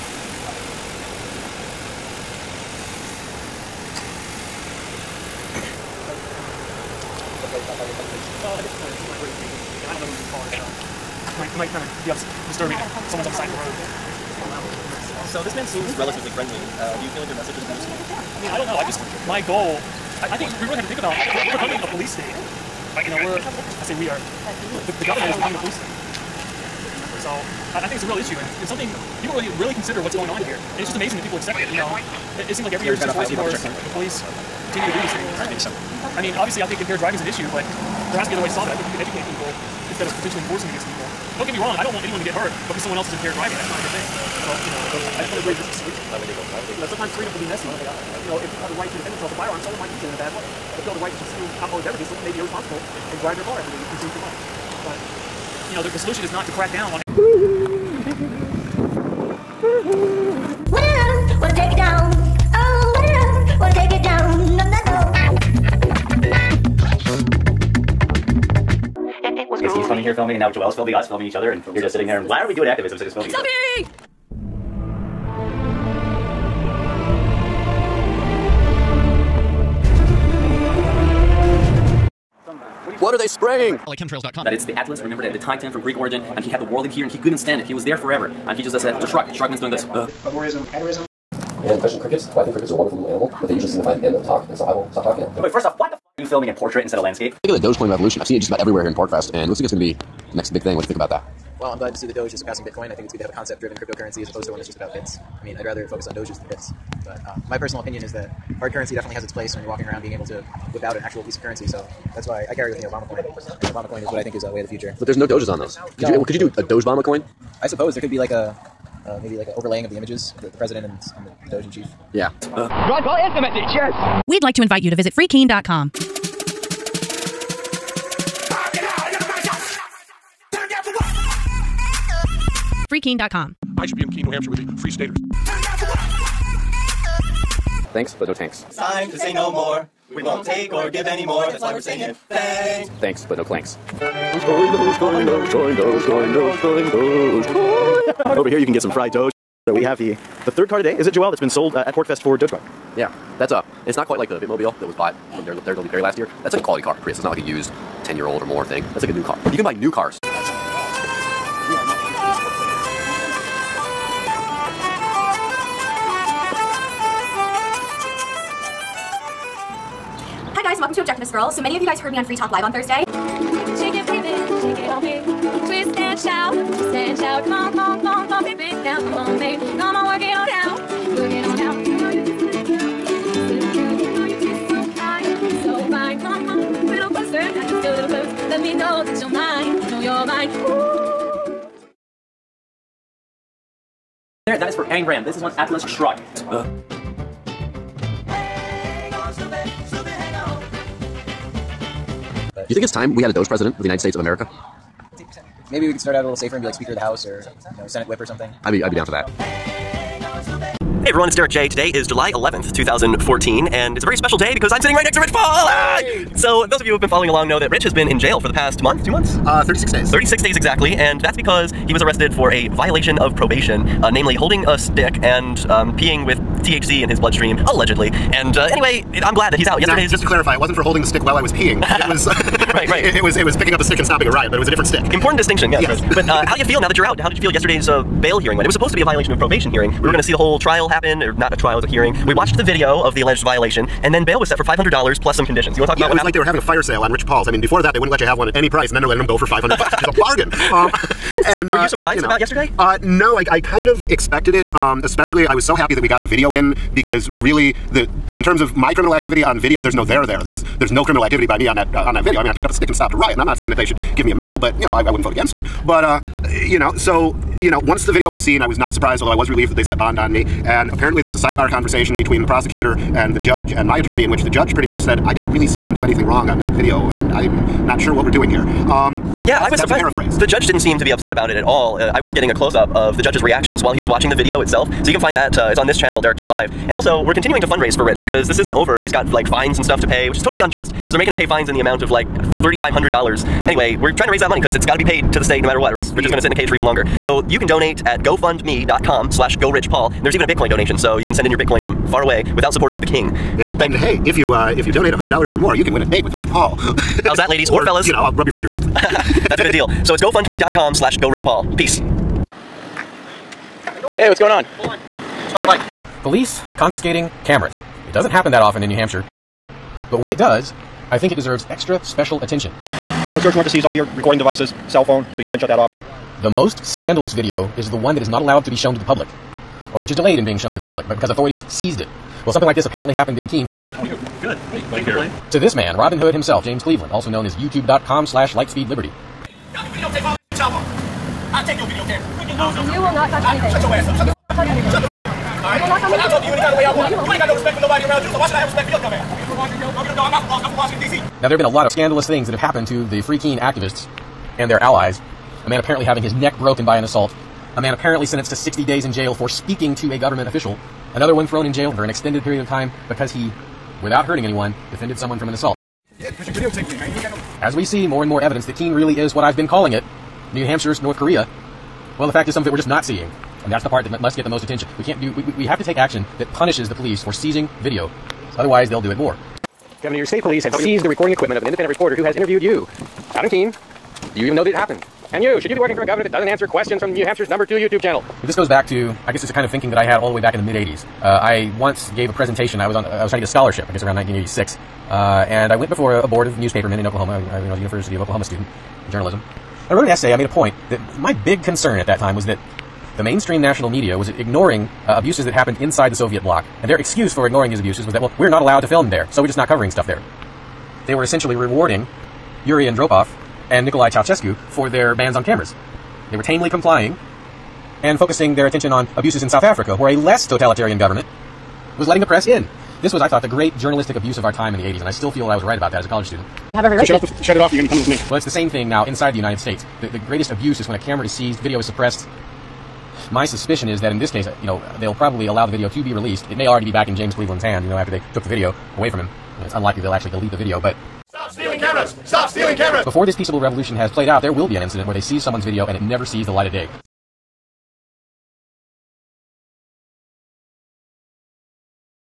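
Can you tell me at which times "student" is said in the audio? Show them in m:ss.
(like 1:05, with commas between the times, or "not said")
6:38, 7:06.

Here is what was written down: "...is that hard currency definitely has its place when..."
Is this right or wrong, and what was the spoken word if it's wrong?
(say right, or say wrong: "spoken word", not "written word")
right.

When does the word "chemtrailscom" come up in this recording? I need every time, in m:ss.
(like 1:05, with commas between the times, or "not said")
1:23.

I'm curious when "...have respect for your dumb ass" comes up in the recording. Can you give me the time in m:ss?
5:48.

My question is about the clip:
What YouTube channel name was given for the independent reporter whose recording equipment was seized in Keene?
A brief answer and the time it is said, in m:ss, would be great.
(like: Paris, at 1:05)
lightspeedliberty, at 5:38.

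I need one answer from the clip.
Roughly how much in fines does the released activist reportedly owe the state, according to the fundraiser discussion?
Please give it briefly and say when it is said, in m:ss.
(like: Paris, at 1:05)
$3,500, at 4:52.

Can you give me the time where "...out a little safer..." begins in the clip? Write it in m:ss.
3:26.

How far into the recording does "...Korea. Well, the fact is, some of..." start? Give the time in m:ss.
6:11.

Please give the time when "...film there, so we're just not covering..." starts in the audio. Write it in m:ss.
6:48.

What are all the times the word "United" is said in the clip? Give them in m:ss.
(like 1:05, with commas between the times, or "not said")
3:23, 7:09.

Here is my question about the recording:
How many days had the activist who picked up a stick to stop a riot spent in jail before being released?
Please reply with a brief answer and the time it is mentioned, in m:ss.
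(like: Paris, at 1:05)
36, at 3:40.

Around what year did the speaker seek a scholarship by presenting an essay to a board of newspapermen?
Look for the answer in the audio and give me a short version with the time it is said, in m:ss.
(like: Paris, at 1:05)
1986, at 6:34.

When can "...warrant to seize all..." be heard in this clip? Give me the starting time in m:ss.
5:23.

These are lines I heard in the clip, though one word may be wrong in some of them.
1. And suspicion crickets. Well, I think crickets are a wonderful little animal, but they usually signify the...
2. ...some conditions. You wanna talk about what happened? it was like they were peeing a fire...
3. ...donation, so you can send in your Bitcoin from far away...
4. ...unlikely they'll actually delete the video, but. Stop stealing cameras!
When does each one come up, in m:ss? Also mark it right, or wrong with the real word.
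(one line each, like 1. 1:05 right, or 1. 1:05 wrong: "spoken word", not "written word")
1. 1:31 wrong: "question", not "suspicion"
2. 4:05 wrong: "having", not "peeing"
3. 5:00 right
4. 7:19 right.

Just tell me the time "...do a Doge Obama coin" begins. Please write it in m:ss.
1:56.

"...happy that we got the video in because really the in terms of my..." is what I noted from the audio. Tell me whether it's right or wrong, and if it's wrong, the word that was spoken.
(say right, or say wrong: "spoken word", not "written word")
right.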